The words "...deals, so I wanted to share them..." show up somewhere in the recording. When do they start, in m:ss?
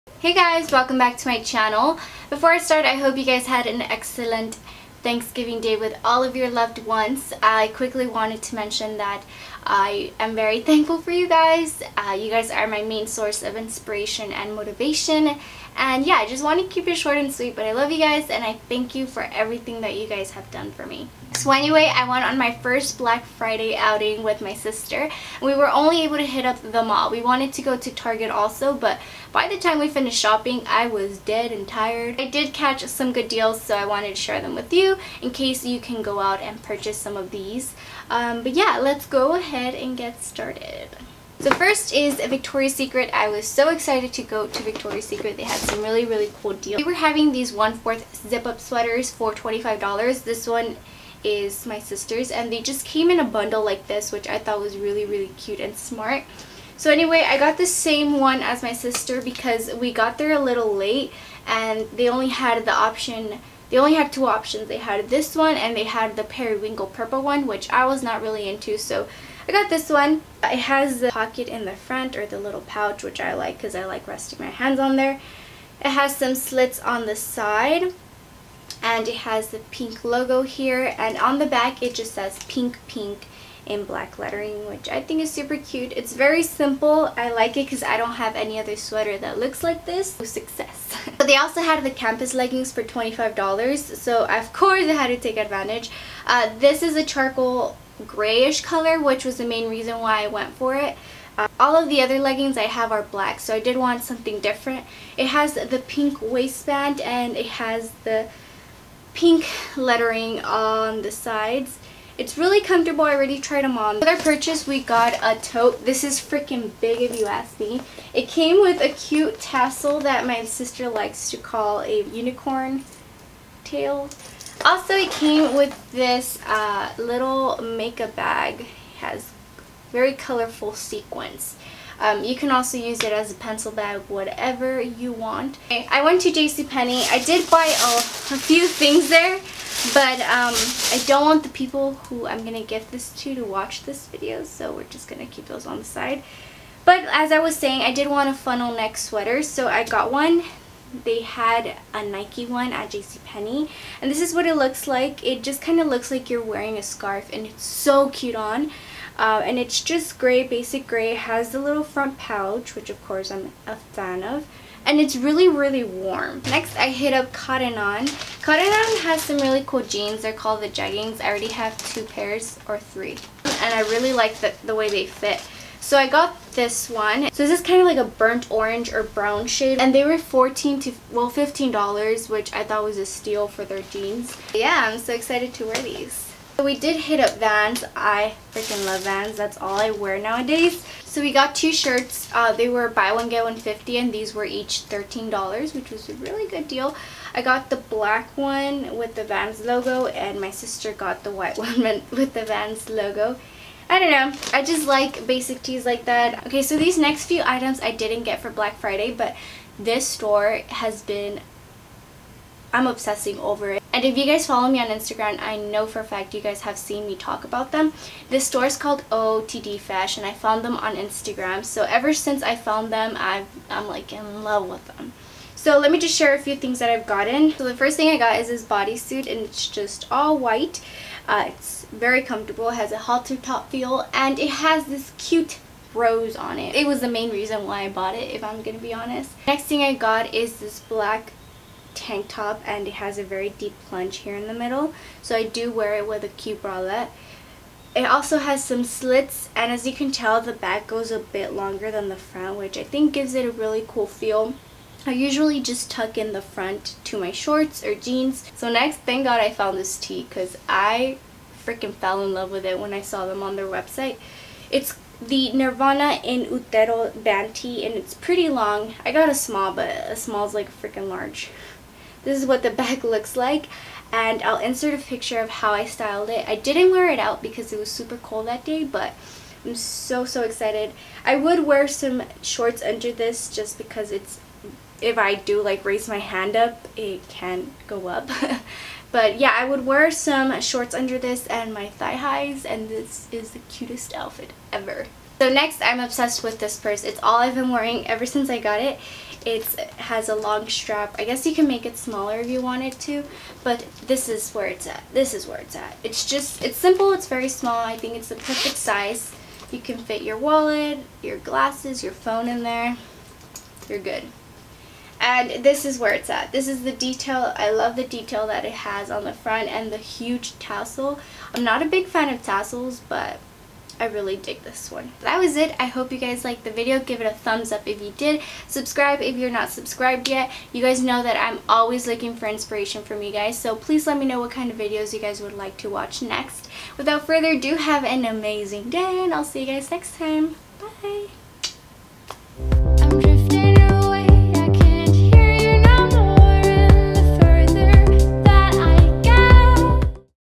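0:33.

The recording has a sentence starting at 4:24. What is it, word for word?
It's the Nirvana in Utero band tee and it's pretty long.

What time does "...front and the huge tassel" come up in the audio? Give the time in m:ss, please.
5:19.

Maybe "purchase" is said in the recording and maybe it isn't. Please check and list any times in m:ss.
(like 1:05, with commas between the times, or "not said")
0:36, 1:54.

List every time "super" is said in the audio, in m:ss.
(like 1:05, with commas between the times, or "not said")
1:25, 4:37.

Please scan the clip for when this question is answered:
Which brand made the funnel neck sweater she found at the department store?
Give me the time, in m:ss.
2:32.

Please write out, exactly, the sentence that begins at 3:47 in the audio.
So the first thing I got is this bodysuit and it's just all white.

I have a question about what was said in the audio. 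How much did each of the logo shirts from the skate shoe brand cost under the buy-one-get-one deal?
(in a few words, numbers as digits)
$13.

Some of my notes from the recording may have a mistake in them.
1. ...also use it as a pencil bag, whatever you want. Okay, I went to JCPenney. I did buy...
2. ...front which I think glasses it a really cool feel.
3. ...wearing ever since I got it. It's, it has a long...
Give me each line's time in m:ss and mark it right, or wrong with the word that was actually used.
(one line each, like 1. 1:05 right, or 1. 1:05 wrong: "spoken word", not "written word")
1. 2:12 right
2. 4:12 wrong: "gives", not "glasses"
3. 4:57 right.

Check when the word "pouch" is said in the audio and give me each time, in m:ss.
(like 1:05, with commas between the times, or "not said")
1:12, 2:42.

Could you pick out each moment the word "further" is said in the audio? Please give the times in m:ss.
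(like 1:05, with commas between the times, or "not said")
5:37.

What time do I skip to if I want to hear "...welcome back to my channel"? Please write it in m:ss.
0:00.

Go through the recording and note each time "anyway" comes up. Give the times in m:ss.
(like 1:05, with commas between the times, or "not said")
0:21, 0:56.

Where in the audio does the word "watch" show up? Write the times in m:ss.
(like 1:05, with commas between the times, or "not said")
2:23, 5:35.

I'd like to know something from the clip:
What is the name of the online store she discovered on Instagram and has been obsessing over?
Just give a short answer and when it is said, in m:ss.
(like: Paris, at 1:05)
OOTD Fashion, at 3:39.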